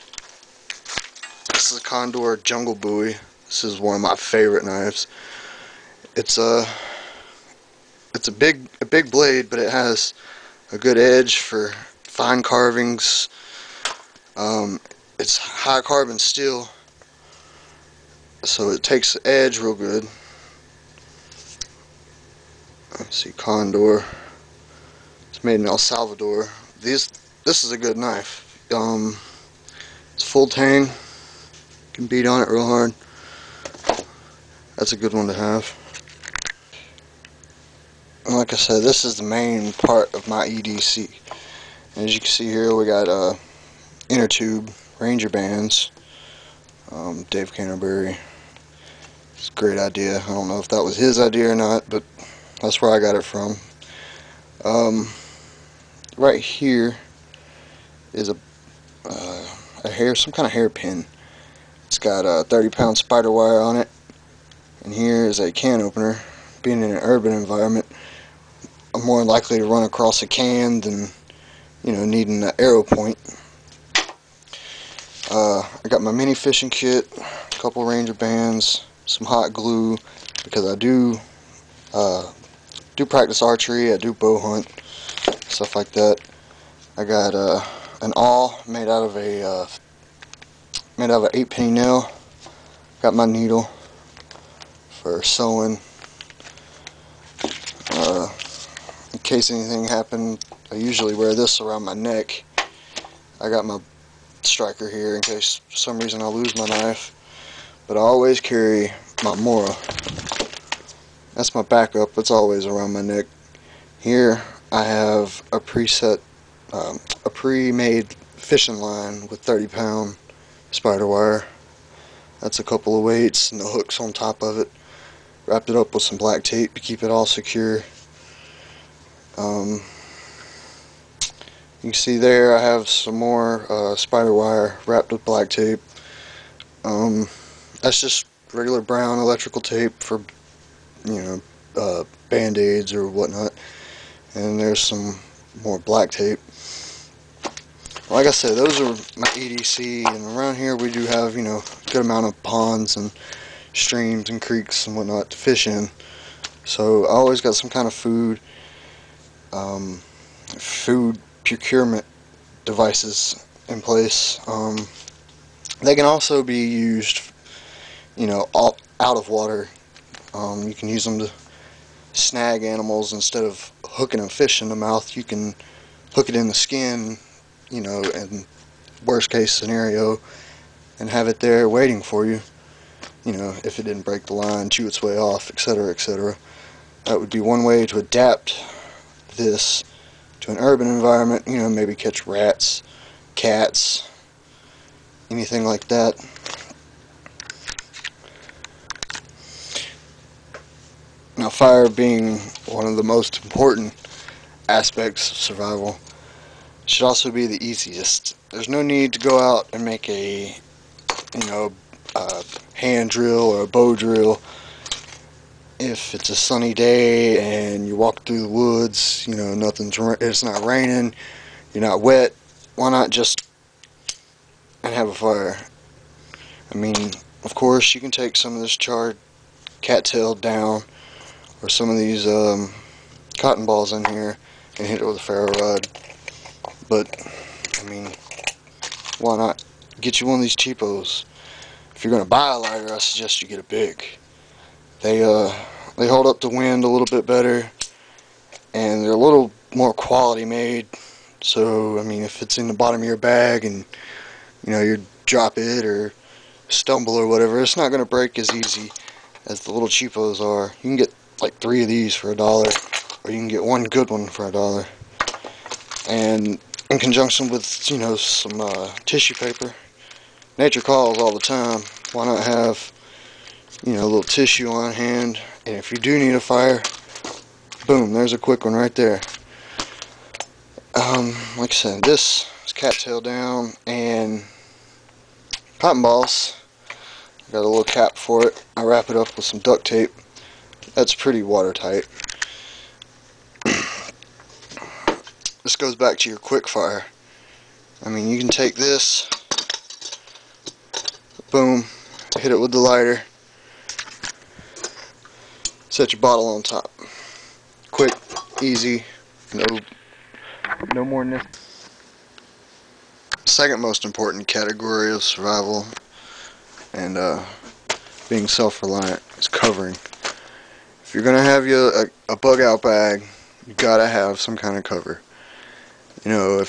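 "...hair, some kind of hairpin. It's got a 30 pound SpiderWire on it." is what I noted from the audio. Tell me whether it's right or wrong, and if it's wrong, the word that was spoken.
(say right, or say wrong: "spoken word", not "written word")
right.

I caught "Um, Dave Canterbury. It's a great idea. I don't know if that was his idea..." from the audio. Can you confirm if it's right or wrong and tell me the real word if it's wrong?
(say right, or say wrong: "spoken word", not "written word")
right.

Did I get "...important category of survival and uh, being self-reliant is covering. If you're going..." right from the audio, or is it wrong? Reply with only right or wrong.
right.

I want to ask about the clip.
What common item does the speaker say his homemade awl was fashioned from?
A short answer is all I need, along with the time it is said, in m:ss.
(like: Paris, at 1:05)
8 penny nail, at 1:31.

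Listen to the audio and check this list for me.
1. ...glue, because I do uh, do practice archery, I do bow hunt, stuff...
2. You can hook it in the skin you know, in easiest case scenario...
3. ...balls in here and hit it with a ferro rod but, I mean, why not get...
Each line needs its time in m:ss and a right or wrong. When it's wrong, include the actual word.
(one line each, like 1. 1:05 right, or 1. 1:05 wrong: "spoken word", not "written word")
1. 1:19 right
2. 2:55 wrong: "worst", not "easiest"
3. 3:53 right.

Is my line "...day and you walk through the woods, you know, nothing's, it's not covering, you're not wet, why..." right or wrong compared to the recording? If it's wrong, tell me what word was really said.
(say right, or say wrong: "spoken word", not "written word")
wrong: "raining", not "covering".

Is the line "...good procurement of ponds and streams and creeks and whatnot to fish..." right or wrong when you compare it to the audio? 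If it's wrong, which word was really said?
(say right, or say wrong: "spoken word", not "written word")
wrong: "amount", not "procurement".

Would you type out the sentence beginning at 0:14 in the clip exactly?
Um, it's high carbon steel, so it takes the edge real good.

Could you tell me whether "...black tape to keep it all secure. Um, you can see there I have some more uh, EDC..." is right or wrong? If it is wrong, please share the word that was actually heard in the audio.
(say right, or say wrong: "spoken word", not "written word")
wrong: "SpiderWire", not "EDC".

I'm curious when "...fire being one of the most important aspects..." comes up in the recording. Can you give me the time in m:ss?
3:21.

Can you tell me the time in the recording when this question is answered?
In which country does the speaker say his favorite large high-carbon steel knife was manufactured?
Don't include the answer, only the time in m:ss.
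0:25.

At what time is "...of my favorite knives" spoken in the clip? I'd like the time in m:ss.
0:03.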